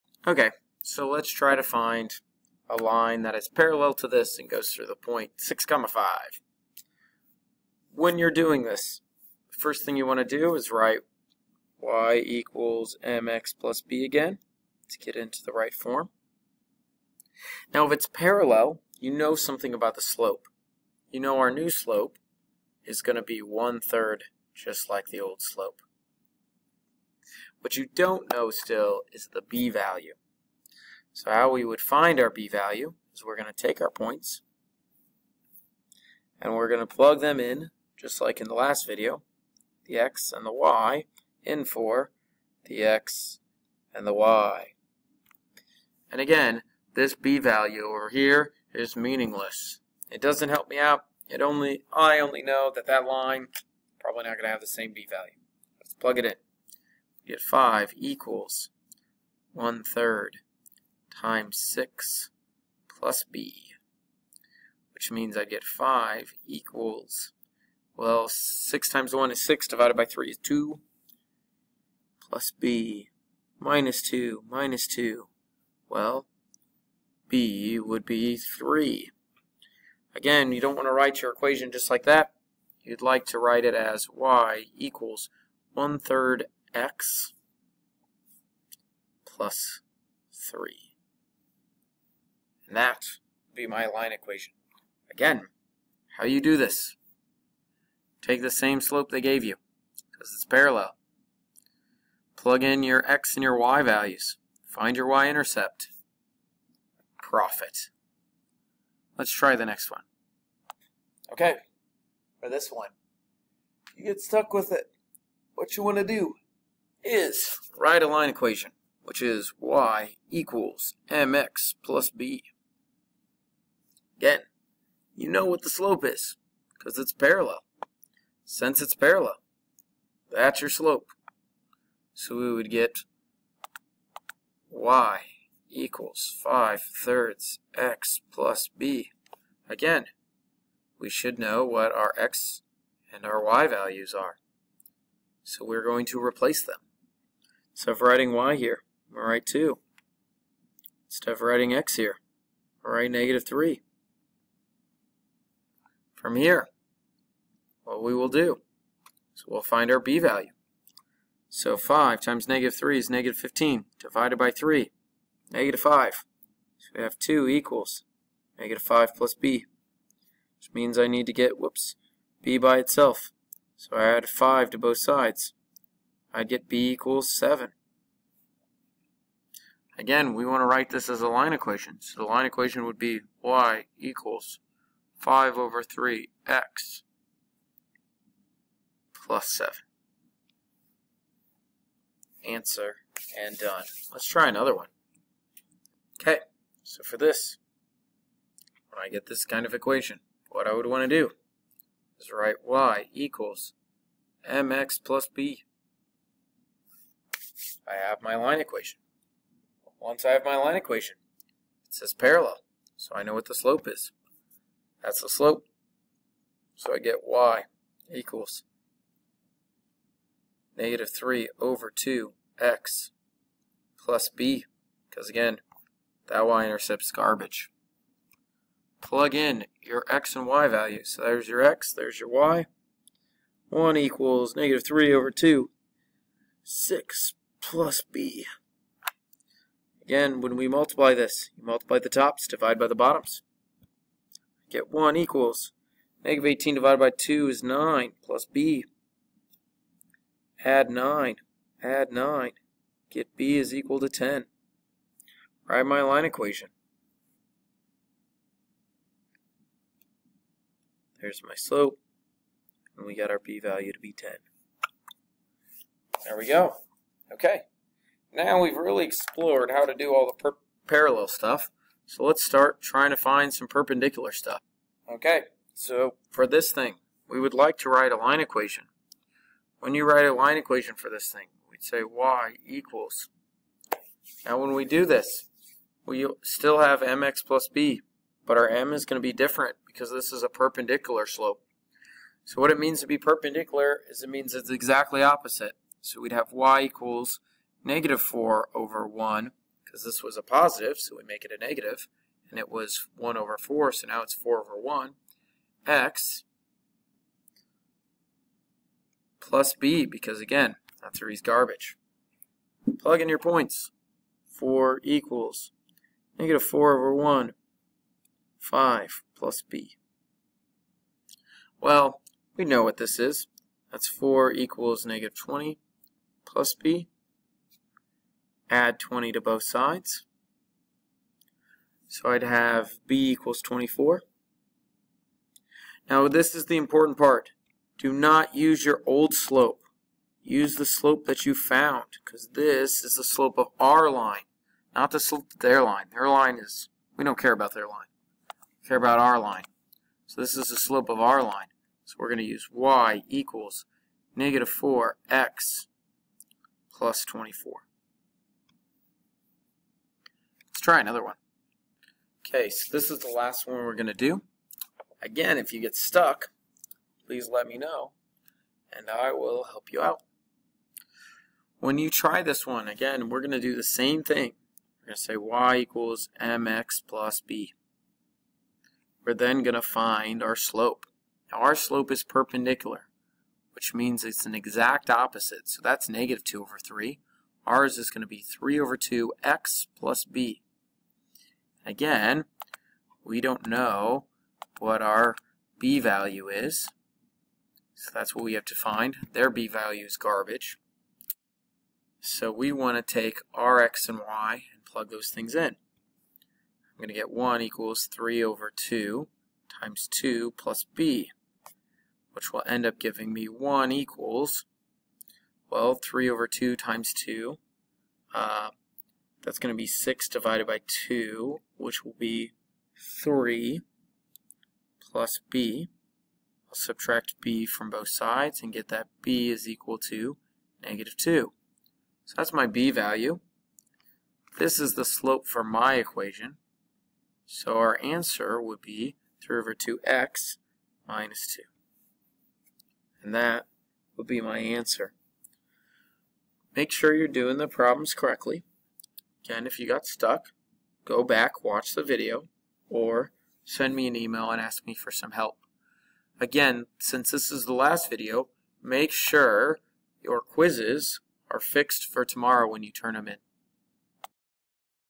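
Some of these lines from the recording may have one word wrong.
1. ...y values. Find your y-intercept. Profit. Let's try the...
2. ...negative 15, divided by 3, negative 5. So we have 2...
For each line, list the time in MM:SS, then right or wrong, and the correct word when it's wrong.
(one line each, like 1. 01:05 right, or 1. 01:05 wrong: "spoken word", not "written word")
1. 01:43 right
2. 02:43 right.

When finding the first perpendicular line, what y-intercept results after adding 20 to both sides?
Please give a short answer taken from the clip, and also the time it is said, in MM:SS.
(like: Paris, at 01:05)
24, at 05:33.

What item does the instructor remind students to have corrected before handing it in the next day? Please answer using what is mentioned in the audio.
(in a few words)
quizzes.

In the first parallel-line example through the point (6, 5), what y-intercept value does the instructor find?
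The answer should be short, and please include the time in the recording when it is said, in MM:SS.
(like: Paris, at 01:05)
3, at 01:17.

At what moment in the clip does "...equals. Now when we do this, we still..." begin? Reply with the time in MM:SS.
04:42.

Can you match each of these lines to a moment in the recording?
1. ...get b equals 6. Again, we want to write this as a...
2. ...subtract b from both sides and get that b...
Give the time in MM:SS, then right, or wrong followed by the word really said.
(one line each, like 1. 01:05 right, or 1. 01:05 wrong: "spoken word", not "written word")
1. 02:56 wrong: "7", not "6"
2. 07:06 right.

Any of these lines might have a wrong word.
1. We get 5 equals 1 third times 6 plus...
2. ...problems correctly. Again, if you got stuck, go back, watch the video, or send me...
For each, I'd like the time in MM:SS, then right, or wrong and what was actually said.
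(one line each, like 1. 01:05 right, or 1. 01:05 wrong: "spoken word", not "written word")
1. 00:57 right
2. 07:27 right.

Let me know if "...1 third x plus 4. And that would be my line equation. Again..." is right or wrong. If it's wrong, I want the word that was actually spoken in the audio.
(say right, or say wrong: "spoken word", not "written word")
wrong: "3", not "4".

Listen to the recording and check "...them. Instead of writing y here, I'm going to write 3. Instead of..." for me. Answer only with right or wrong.
wrong.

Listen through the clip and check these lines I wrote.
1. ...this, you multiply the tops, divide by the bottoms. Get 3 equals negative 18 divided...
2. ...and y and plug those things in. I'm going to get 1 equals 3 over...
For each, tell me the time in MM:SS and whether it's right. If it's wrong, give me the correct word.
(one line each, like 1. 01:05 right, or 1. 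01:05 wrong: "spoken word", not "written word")
1. 04:01 wrong: "1", not "3"
2. 06:44 right.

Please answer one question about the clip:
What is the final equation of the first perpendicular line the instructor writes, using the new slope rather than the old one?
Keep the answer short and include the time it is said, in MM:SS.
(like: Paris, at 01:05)
y = -4x + 24, at 05:52.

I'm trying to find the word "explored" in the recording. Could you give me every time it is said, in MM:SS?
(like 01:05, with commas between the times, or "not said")
04:29.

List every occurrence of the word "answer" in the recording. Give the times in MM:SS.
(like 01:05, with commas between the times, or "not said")
03:12, 07:18, 07:24.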